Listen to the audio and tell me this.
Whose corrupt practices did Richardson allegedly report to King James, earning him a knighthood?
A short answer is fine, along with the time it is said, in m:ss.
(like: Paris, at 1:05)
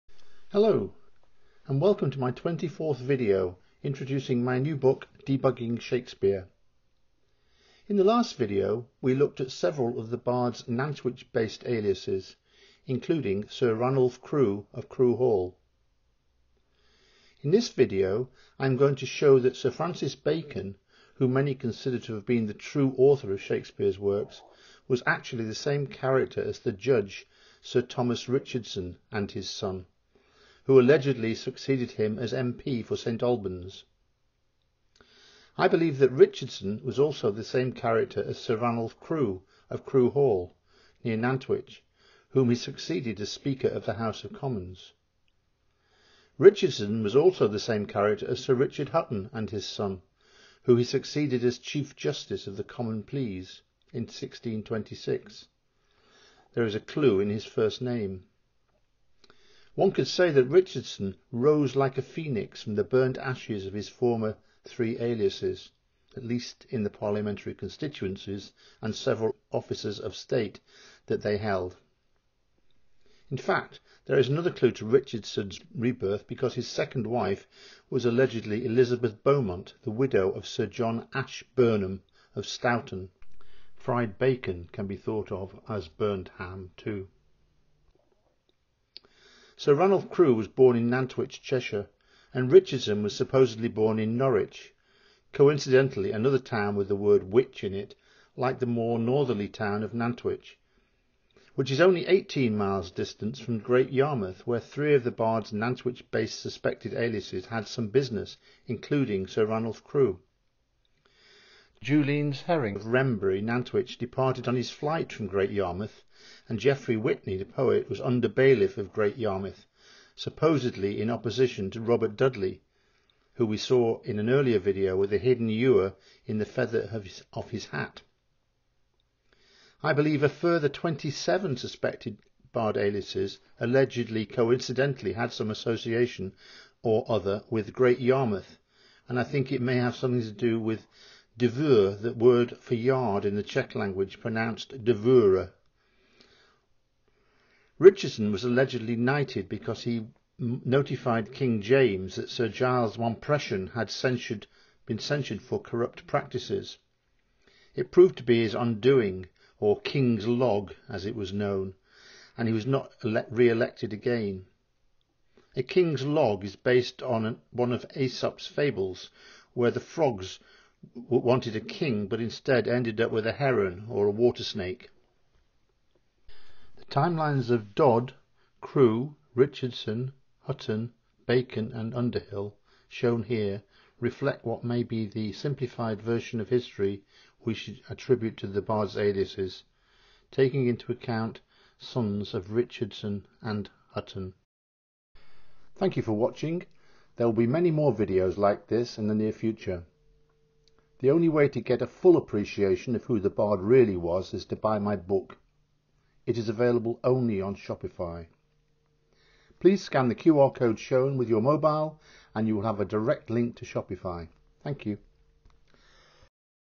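Sir Giles Mompesson, at 2:32.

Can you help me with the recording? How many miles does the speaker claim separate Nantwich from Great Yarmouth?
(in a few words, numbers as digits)
18.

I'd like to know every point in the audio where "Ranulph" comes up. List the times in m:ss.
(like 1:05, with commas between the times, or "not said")
0:13, 0:38, 1:29, 1:49.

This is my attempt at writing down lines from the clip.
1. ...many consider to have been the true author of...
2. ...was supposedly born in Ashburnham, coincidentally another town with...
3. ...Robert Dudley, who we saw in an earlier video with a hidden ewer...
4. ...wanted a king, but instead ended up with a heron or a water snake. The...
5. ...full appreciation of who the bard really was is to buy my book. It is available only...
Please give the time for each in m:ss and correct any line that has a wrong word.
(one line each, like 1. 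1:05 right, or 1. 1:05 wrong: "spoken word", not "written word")
1. 0:21 right
2. 1:33 wrong: "Norwich", not "Ashburnham"
3. 2:01 right
4. 2:51 right
5. 3:21 right.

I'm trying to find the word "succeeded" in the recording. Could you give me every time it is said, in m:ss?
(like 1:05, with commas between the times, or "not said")
0:31, 0:42, 0:50.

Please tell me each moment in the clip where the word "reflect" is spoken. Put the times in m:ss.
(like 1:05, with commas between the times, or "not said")
3:03.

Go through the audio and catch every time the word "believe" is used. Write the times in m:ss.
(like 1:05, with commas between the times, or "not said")
0:35, 2:09.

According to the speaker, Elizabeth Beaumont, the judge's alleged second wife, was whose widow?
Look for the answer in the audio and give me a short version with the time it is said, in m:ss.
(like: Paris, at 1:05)
Sir John Ashburnham, at 1:20.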